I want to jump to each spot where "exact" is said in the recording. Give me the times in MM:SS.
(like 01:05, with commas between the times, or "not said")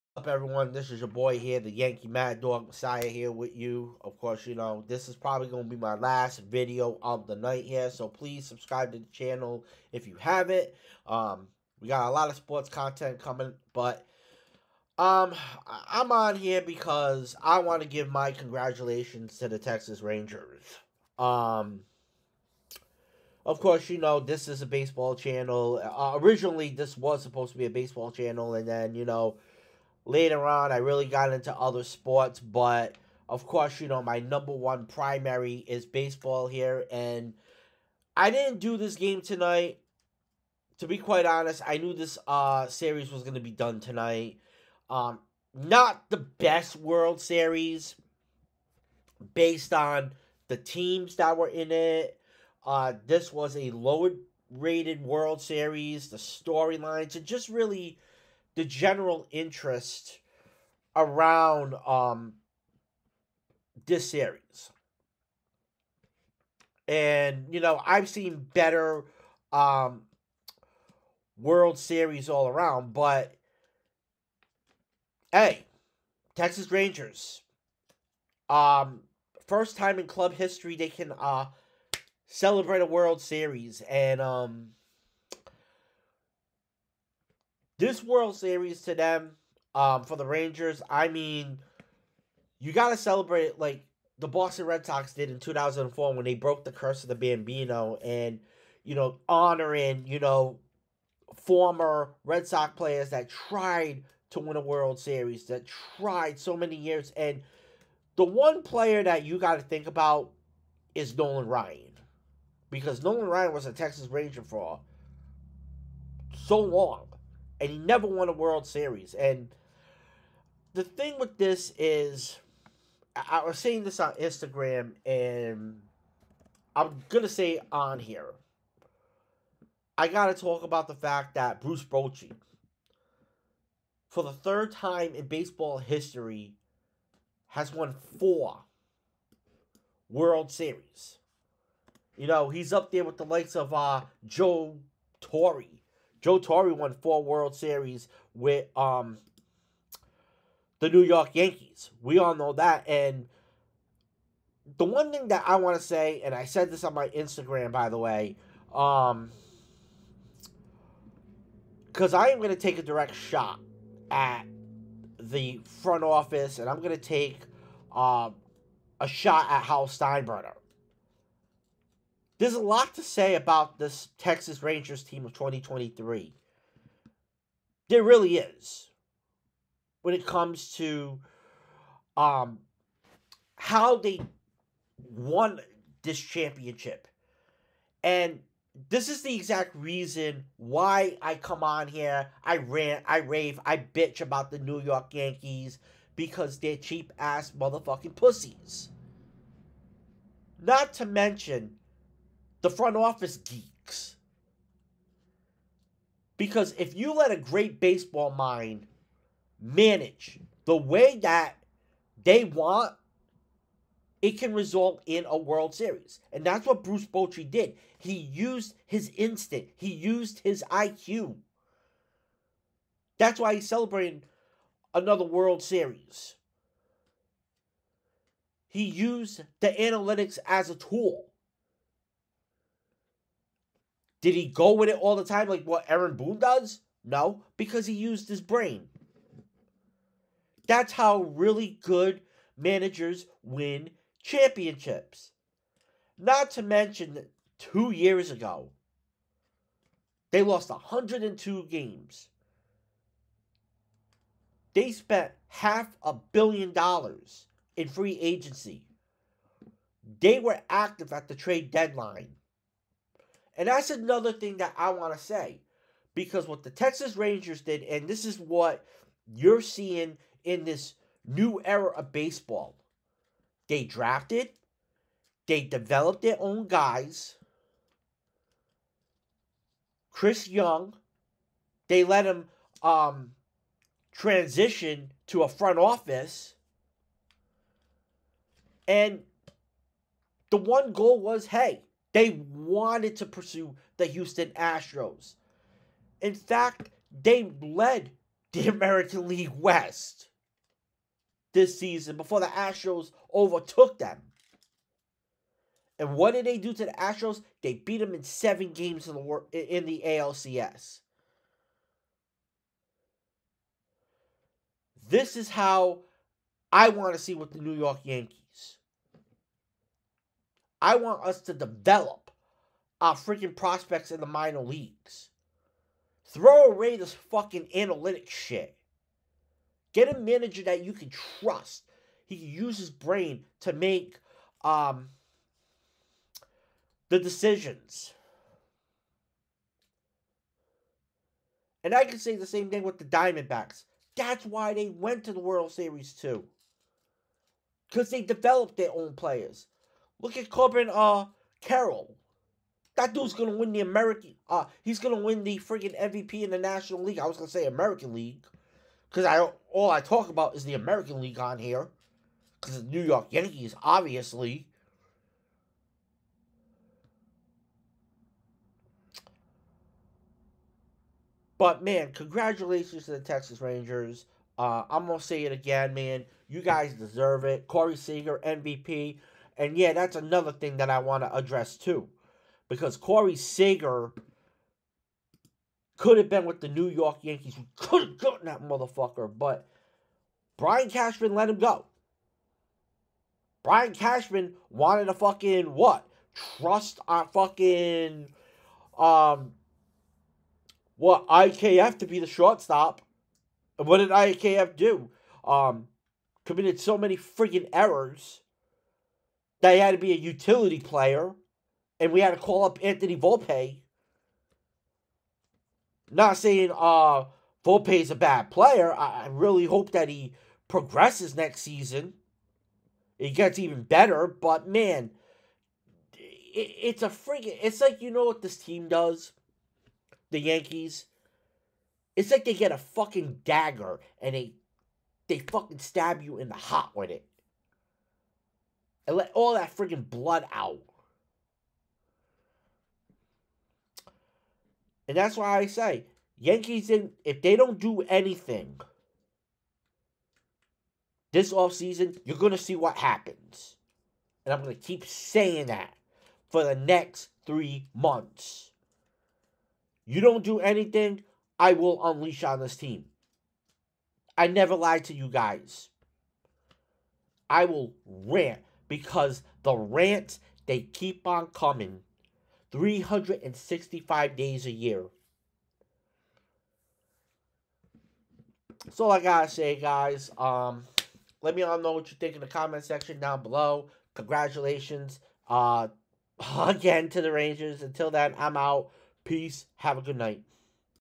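03:09.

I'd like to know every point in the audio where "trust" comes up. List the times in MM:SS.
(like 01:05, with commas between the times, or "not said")
05:31, 06:36.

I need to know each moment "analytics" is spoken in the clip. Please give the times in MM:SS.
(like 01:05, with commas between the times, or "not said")
03:49, 05:27.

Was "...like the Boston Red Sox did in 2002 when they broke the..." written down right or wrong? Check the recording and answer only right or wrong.
wrong.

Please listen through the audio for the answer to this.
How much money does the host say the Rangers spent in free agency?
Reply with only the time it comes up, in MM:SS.
04:15.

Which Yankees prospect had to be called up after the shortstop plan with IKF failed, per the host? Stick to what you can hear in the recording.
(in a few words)
Anthony Volpe.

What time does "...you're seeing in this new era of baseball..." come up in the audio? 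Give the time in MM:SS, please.
04:29.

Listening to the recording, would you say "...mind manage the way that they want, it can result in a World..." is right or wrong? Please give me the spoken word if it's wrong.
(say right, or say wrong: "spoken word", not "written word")
right.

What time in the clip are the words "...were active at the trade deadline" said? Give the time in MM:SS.
04:20.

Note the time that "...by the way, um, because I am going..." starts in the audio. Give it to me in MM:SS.
02:37.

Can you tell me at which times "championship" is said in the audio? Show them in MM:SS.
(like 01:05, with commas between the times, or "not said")
03:06, 04:04.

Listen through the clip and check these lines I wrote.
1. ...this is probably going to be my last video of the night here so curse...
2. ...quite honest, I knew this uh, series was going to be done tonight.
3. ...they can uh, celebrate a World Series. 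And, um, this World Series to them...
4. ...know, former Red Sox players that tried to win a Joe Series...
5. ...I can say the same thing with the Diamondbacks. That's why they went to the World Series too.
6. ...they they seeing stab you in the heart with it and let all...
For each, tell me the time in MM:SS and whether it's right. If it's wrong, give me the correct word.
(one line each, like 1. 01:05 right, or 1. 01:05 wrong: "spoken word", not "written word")
1. 00:04 wrong: "please", not "curse"
2. 00:40 right
3. 01:20 right
4. 01:40 wrong: "World", not "Joe"
5. 05:41 right
6. 07:14 wrong: "fucking", not "seeing".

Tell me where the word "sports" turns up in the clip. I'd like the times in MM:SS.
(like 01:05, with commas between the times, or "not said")
00:12, 00:31.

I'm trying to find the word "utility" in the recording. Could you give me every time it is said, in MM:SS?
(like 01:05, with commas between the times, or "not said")
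06:50.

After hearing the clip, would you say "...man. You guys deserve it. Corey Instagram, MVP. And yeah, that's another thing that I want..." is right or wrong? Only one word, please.
wrong.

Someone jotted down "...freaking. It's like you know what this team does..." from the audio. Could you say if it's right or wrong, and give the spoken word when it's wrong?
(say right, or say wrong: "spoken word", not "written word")
right.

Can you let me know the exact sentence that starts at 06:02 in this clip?
Cause the New York Yankees, obviously.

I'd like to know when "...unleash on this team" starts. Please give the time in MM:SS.
07:42.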